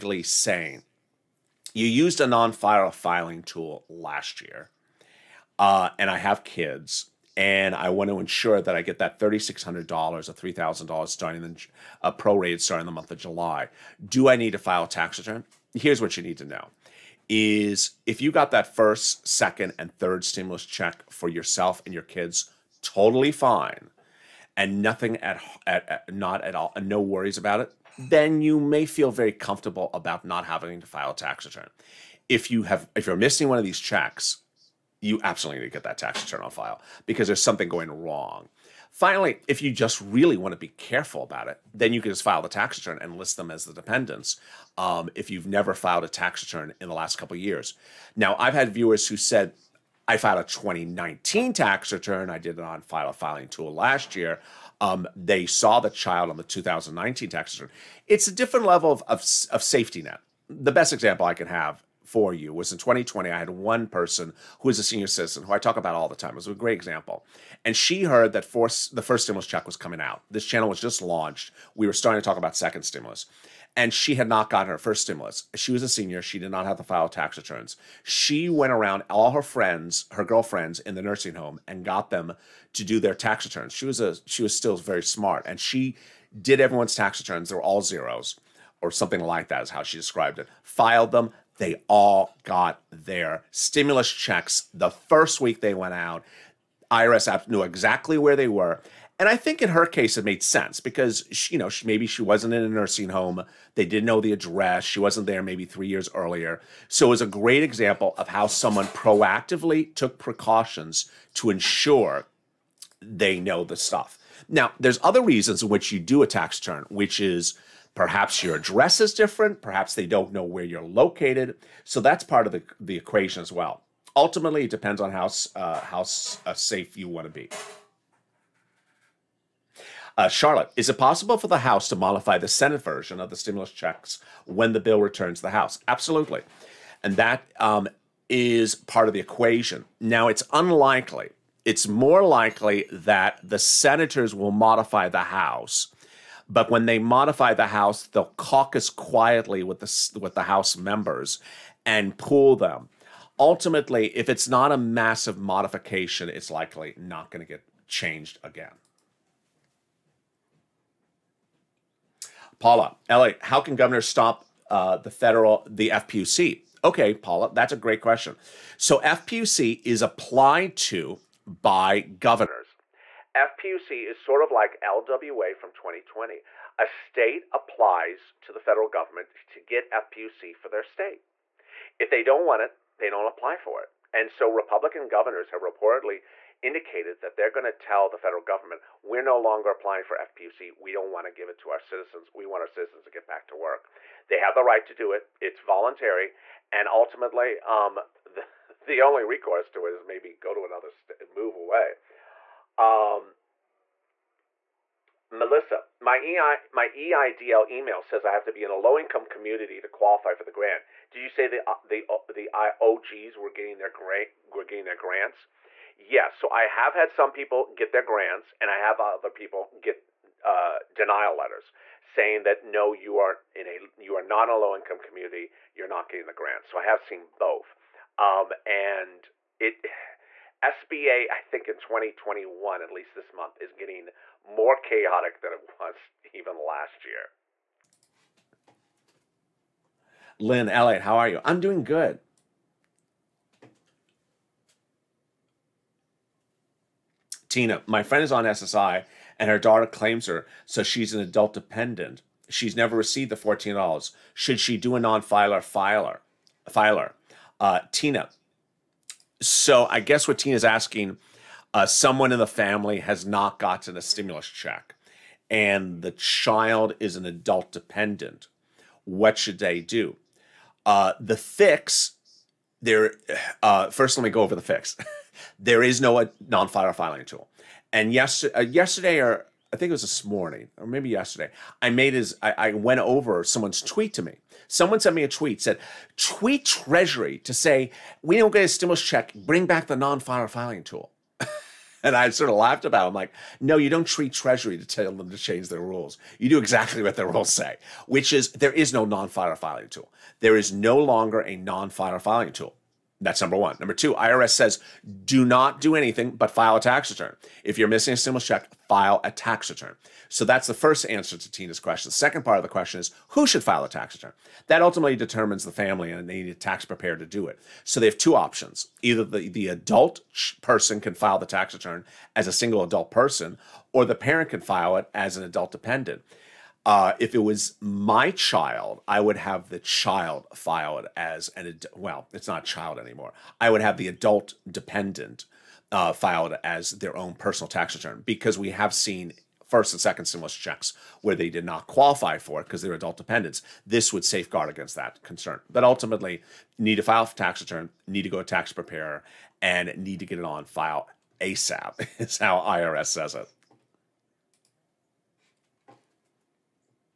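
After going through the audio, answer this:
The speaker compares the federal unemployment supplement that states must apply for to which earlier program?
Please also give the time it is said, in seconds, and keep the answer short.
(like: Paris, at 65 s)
LWA, at 174 s.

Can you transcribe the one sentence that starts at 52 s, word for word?
I did it on file a filing tool last year.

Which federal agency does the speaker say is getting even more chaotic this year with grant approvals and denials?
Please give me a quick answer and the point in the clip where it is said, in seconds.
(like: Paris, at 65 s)
SBA, at 230 s.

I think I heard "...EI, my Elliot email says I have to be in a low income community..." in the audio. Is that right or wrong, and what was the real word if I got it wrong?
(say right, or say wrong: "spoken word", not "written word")
wrong: "EIDL", not "Elliot".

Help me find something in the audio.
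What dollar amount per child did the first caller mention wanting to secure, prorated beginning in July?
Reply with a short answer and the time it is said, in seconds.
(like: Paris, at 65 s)
$3,600, at 9 s.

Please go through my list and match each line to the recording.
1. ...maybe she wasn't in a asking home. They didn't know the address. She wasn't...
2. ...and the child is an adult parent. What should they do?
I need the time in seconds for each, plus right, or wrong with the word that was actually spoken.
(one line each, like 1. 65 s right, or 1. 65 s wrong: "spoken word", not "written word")
1. 101 s wrong: "nursing", not "asking"
2. 265 s wrong: "dependent", not "parent".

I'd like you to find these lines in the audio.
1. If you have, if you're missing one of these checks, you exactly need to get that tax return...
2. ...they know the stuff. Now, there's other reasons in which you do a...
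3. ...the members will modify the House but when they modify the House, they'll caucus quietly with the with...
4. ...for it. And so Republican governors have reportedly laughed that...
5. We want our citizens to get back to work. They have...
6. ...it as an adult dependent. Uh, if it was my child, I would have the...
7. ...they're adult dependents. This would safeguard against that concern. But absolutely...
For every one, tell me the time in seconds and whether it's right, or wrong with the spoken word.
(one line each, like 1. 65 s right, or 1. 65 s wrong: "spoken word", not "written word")
1. 32 s wrong: "absolutely", not "exactly"
2. 113 s right
3. 143 s wrong: "senators", not "members"
4. 183 s wrong: "indicated", not "laughed"
5. 192 s right
6. 324 s right
7. 342 s wrong: "ultimately", not "absolutely".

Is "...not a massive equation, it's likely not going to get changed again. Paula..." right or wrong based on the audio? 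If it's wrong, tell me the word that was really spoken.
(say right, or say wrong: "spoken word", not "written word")
wrong: "modification", not "equation".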